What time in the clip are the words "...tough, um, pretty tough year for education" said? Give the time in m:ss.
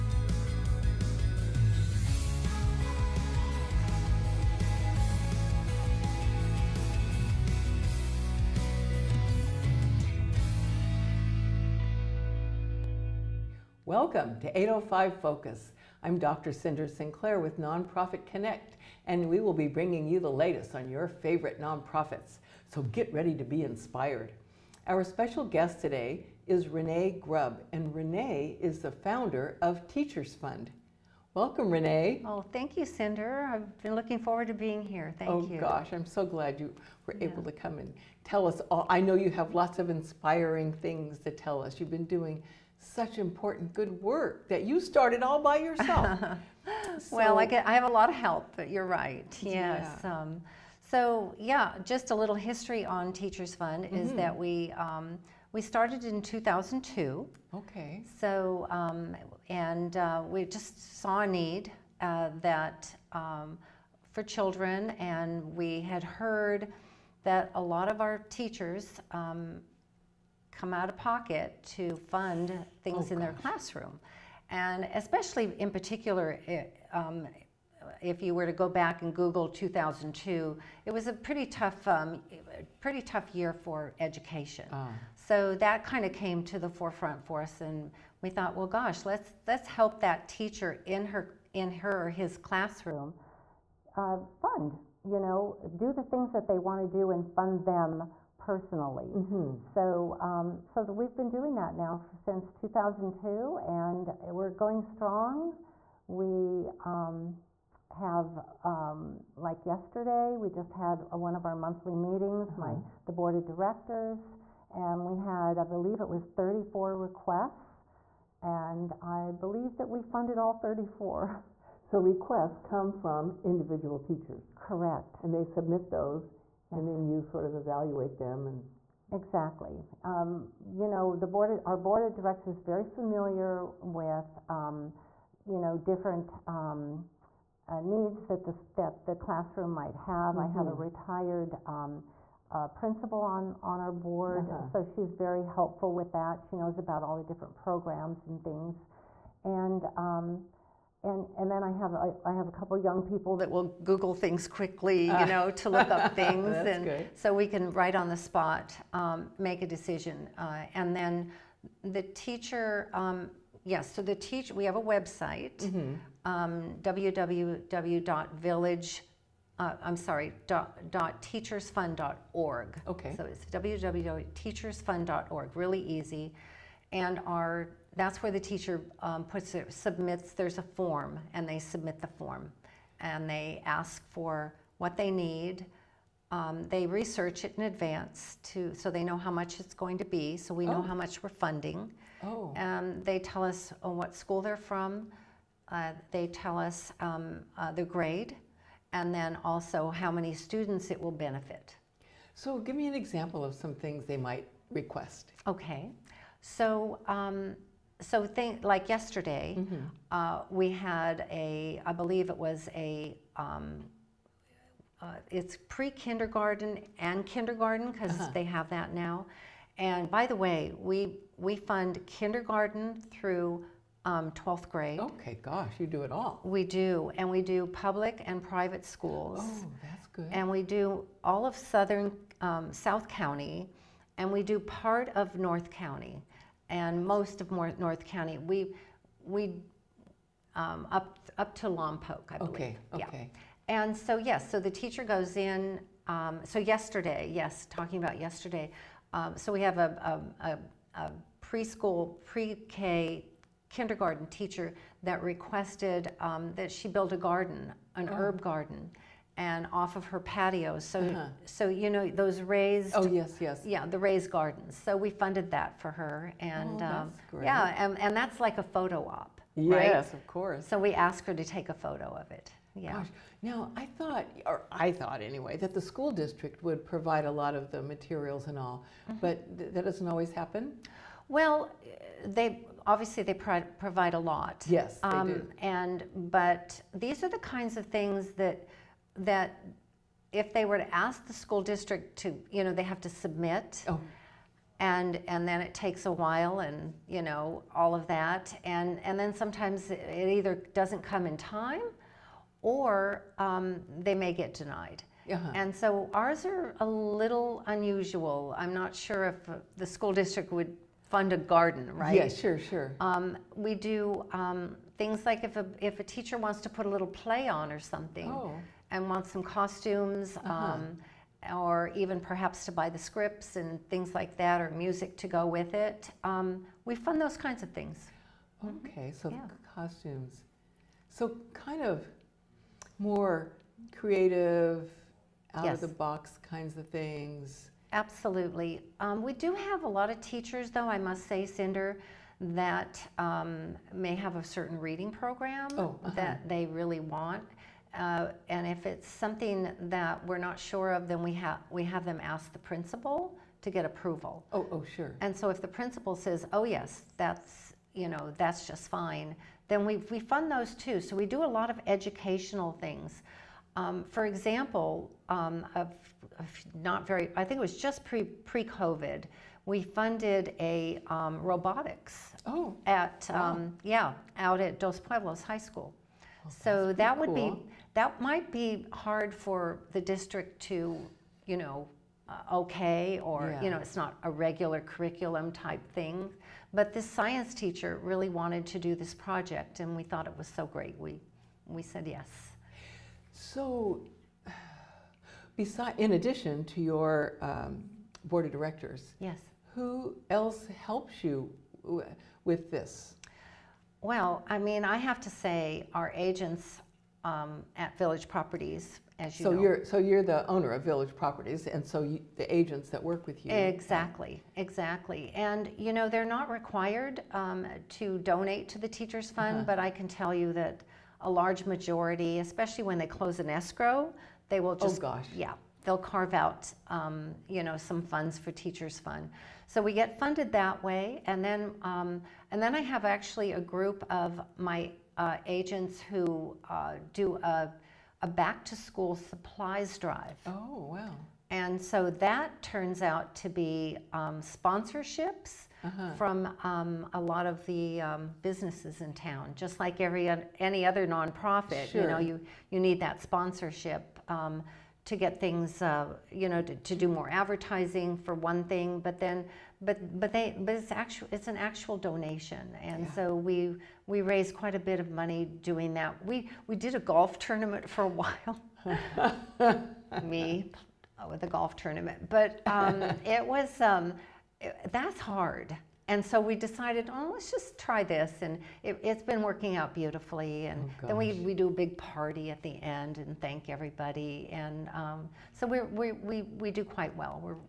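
1:21.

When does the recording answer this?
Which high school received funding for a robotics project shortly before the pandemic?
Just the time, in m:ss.
6:14.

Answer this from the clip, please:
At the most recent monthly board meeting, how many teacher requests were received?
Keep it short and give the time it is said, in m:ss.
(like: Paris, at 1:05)
34, at 1:55.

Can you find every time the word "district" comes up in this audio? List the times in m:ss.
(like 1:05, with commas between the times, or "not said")
4:36, 4:51, 5:10, 6:20.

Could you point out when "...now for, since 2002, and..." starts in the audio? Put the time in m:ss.
1:41.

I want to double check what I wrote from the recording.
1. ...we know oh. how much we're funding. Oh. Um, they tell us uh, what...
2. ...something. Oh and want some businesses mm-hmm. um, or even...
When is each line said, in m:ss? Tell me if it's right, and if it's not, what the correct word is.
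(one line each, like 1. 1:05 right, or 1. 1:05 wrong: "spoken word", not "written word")
1. 3:10 right
2. 5:17 wrong: "costumes", not "businesses".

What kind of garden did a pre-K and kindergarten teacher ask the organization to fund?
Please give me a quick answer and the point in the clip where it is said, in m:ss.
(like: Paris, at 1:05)
Herb garden, at 4:18.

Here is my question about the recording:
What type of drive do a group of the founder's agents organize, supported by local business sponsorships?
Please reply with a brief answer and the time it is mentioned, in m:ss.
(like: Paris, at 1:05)
Back to school supplies drive, at 7:18.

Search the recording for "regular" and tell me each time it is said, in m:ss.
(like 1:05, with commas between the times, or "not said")
6:24.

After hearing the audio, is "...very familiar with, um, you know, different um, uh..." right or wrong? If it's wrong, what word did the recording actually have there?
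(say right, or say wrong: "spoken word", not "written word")
right.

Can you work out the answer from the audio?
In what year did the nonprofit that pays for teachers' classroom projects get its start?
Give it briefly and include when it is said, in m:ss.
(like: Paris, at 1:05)
2002, at 0:55.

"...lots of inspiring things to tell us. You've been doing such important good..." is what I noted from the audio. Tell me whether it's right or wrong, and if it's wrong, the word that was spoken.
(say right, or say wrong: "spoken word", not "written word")
right.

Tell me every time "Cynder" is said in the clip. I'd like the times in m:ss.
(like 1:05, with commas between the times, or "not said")
0:16, 0:32, 5:41.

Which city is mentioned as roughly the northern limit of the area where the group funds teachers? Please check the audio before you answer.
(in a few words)
Lompoc.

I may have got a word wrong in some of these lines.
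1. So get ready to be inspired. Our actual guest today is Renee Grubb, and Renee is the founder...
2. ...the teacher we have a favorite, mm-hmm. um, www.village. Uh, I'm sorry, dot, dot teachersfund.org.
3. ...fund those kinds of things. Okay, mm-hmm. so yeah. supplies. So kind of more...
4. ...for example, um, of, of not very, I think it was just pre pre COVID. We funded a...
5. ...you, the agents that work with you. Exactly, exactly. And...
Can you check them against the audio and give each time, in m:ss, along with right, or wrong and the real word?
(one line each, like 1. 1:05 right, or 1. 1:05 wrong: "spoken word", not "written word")
1. 0:22 wrong: "special", not "actual"
2. 2:44 wrong: "website", not "favorite"
3. 5:26 wrong: "costumes", not "supplies"
4. 6:04 right
5. 6:52 right.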